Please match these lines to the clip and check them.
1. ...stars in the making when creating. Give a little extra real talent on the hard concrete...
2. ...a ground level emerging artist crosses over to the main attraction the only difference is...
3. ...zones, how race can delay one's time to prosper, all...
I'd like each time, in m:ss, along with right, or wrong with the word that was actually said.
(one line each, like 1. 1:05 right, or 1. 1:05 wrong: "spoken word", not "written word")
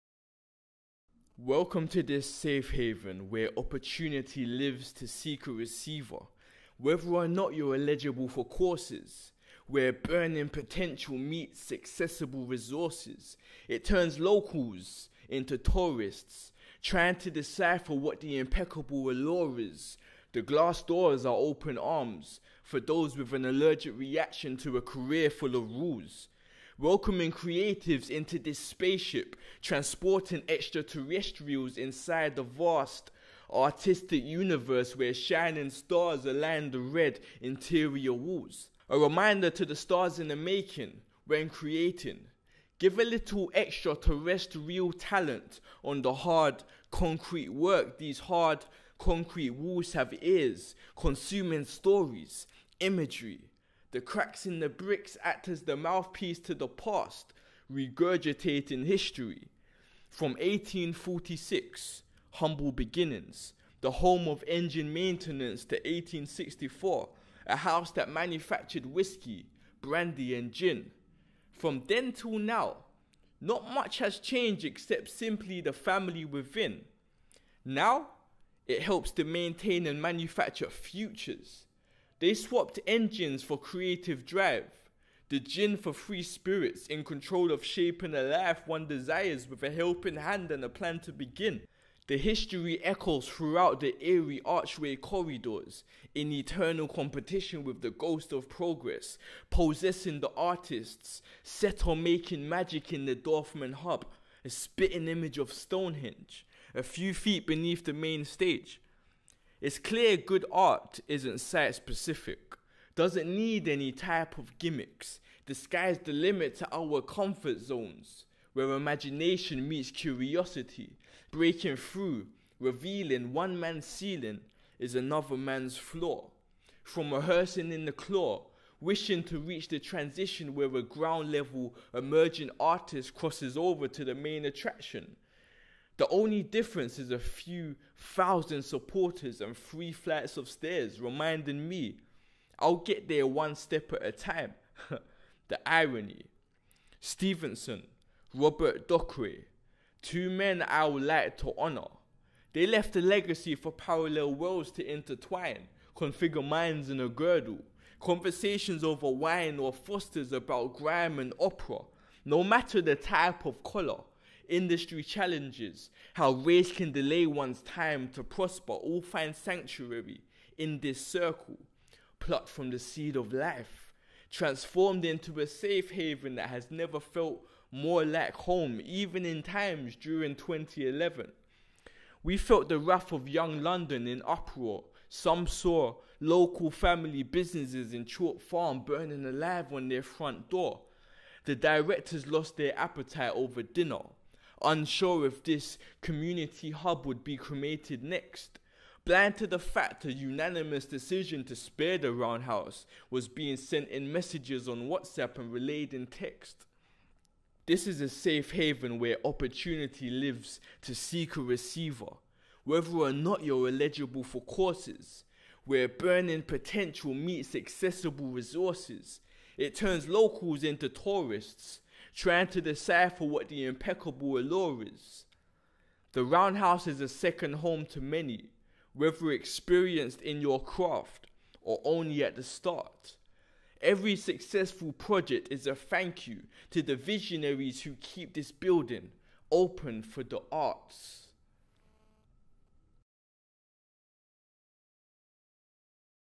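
1. 0:39 right
2. 2:10 right
3. 2:45 wrong: "challenges", not "zones".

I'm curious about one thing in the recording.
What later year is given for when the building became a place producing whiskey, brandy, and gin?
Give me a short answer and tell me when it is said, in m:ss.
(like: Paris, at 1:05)
1864, at 1:05.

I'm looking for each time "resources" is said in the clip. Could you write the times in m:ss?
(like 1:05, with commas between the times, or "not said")
0:12, 3:38.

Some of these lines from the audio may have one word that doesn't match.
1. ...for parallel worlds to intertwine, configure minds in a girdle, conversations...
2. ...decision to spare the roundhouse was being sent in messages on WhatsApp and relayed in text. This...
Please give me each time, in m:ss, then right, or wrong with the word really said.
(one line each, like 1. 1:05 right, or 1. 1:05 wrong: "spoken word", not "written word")
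1. 2:33 right
2. 3:20 right.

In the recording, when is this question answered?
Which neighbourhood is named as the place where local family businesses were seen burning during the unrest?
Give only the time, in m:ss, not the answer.
3:08.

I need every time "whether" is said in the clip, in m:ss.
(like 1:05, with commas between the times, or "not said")
0:06, 3:32, 3:48.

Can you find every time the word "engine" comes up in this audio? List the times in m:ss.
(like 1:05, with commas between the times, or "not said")
1:04, 1:22.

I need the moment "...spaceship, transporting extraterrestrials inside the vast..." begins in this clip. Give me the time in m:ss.
0:28.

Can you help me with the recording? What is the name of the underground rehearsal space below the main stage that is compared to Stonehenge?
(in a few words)
Dorfman Hub.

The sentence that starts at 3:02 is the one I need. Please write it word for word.
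We felt the wrath of young London in uproar.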